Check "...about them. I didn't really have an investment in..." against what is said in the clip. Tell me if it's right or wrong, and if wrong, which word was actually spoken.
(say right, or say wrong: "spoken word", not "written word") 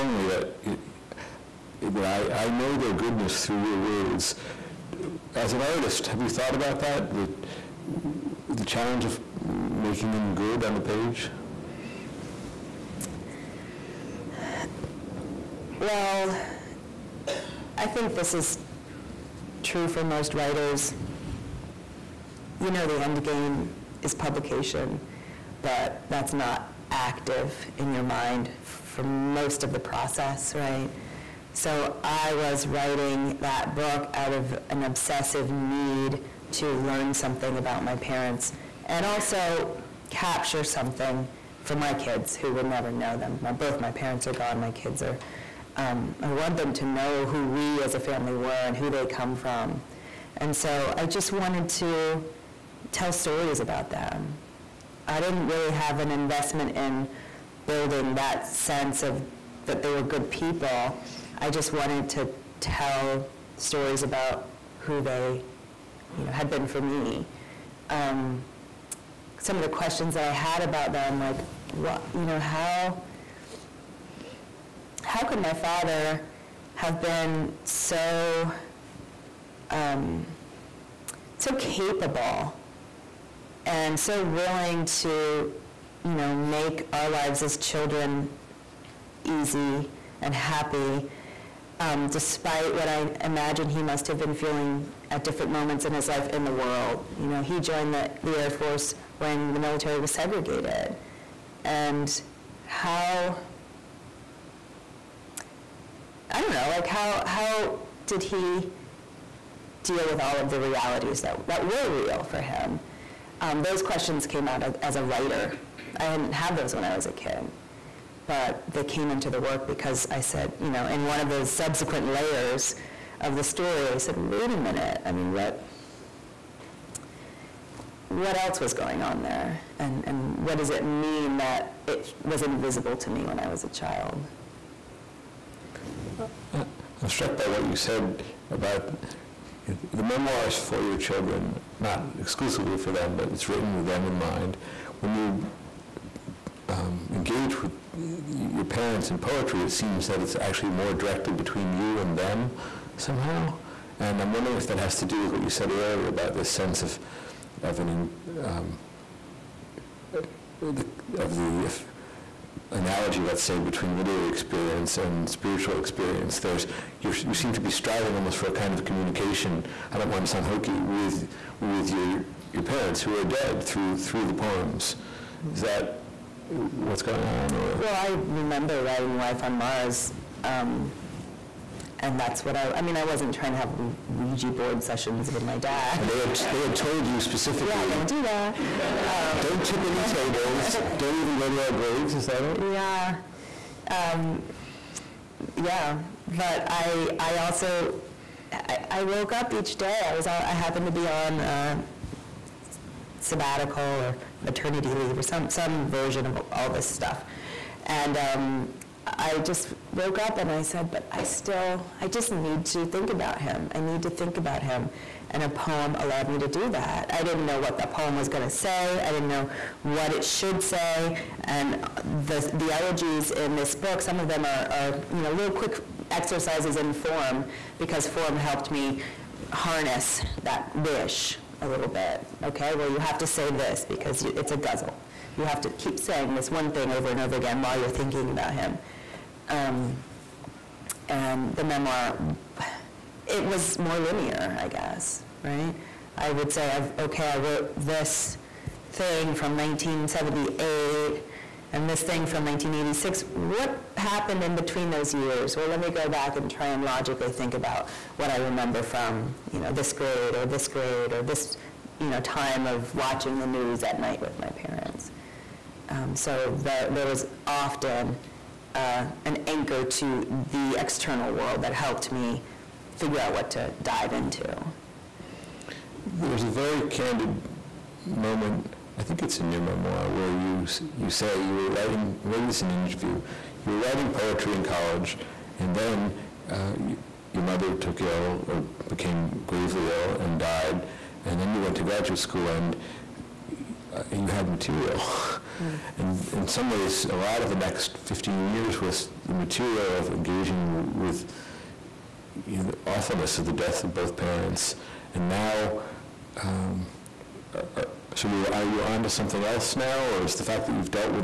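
right.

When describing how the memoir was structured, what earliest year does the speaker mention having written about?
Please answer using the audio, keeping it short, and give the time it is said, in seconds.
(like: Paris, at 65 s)
1978, at 249 s.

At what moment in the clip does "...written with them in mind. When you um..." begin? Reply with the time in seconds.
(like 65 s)
143 s.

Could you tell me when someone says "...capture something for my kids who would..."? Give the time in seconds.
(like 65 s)
40 s.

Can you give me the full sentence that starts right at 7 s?
The, the challenge of making them good on the page?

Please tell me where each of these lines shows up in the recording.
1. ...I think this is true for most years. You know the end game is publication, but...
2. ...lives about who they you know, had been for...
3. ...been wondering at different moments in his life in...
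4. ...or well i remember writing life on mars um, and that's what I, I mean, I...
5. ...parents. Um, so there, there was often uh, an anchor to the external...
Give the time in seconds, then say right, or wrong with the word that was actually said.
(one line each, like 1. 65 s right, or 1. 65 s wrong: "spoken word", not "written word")
1. 17 s wrong: "writers", not "years"
2. 63 s wrong: "stories", not "lives"
3. 94 s wrong: "feeling", not "wondering"
4. 177 s right
5. 264 s right.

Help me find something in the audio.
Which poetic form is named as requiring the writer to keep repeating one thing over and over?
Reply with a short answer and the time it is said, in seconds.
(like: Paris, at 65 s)
Ghazal, at 234 s.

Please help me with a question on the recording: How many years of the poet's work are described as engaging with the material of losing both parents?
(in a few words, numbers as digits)
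15.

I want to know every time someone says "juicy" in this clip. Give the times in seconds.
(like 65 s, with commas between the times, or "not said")
not said.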